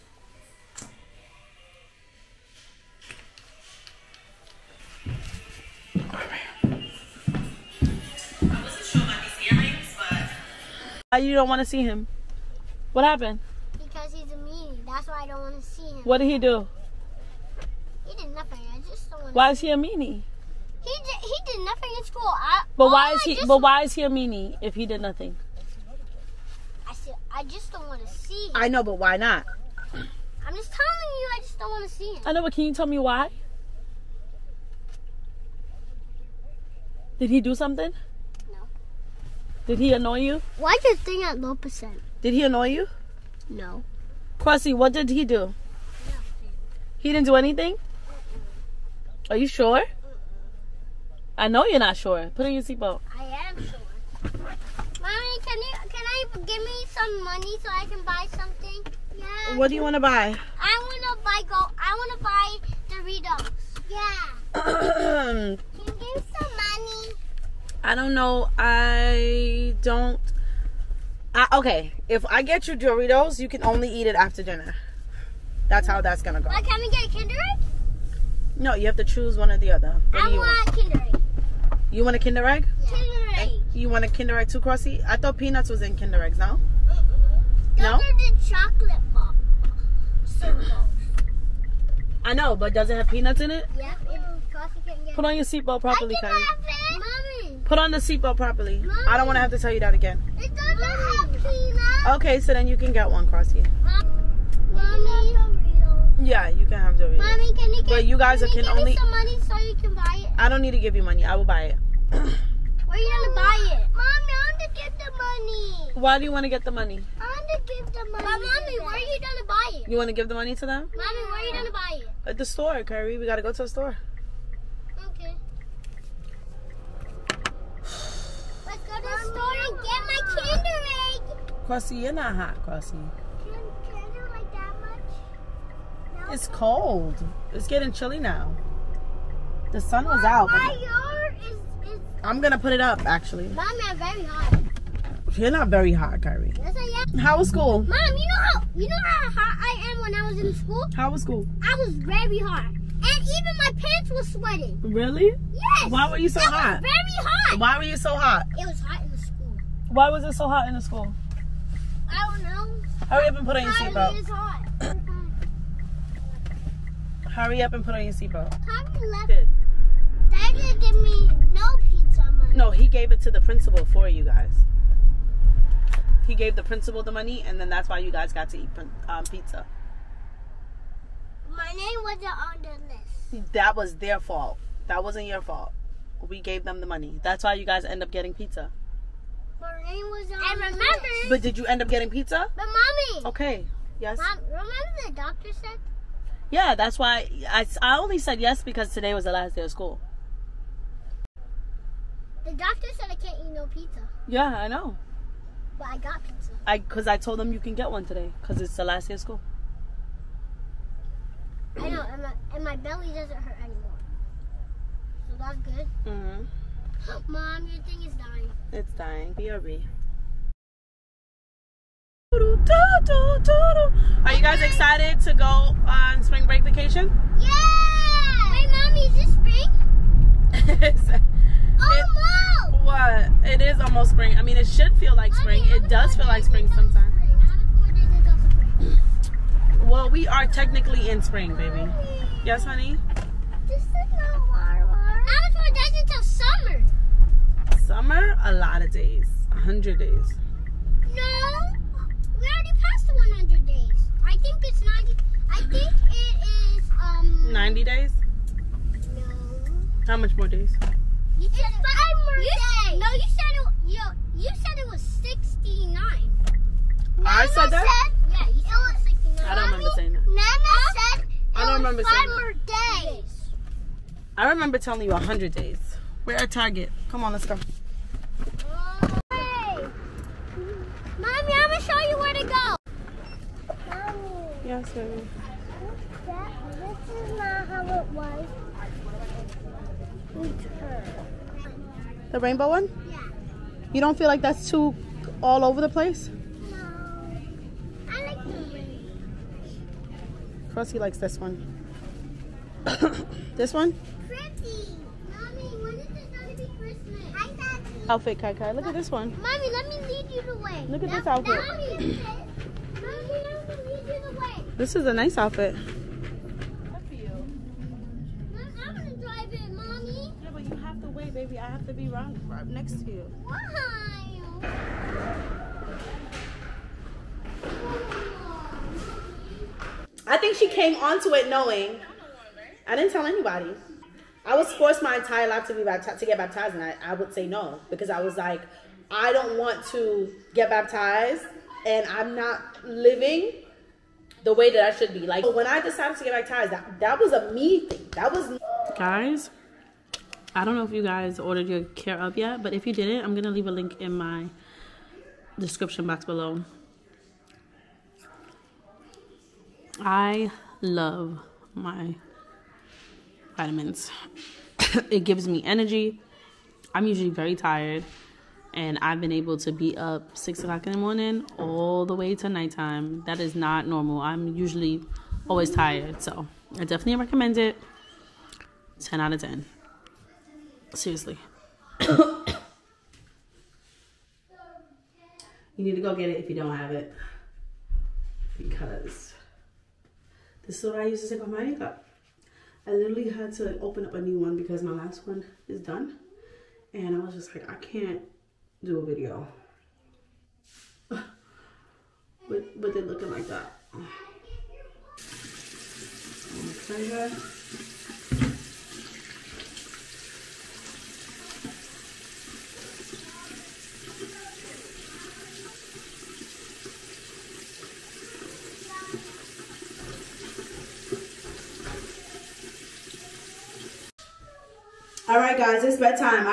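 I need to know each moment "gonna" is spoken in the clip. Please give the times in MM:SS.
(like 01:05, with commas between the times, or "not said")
01:16, 05:53.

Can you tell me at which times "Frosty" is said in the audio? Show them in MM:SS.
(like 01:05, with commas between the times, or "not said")
05:00.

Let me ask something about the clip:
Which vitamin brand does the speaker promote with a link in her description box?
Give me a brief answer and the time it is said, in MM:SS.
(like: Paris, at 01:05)
Care/of, at 05:51.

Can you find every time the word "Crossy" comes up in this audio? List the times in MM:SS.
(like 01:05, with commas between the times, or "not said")
01:24, 01:43.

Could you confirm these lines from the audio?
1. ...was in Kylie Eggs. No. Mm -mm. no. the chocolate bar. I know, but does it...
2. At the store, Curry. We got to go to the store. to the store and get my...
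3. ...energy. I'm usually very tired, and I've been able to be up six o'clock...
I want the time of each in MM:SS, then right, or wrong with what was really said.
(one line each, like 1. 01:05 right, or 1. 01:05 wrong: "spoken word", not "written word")
1. 01:25 wrong: "Kinder", not "Kylie"
2. 02:02 right
3. 06:05 right.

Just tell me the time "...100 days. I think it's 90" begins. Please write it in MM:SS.
04:13.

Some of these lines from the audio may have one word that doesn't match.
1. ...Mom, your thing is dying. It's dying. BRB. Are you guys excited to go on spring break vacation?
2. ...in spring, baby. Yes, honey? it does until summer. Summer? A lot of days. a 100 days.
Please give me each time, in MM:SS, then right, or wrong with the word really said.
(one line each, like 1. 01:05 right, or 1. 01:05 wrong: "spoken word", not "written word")
1. 03:37 right
2. 04:01 right.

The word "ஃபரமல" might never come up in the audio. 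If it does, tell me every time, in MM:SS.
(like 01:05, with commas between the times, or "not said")
not said.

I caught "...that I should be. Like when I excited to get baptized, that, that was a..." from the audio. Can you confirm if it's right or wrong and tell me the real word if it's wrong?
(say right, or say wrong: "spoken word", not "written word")
wrong: "decided", not "excited".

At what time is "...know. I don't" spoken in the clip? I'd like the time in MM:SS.
01:08.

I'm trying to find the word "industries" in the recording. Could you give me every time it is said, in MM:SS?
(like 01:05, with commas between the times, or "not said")
not said.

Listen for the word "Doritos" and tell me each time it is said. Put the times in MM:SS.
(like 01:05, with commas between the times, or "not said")
01:02, 01:12, 01:46.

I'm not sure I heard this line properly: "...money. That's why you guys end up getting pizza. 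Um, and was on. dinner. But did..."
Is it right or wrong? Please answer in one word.
wrong.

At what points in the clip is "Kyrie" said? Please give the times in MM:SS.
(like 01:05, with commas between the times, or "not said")
02:26.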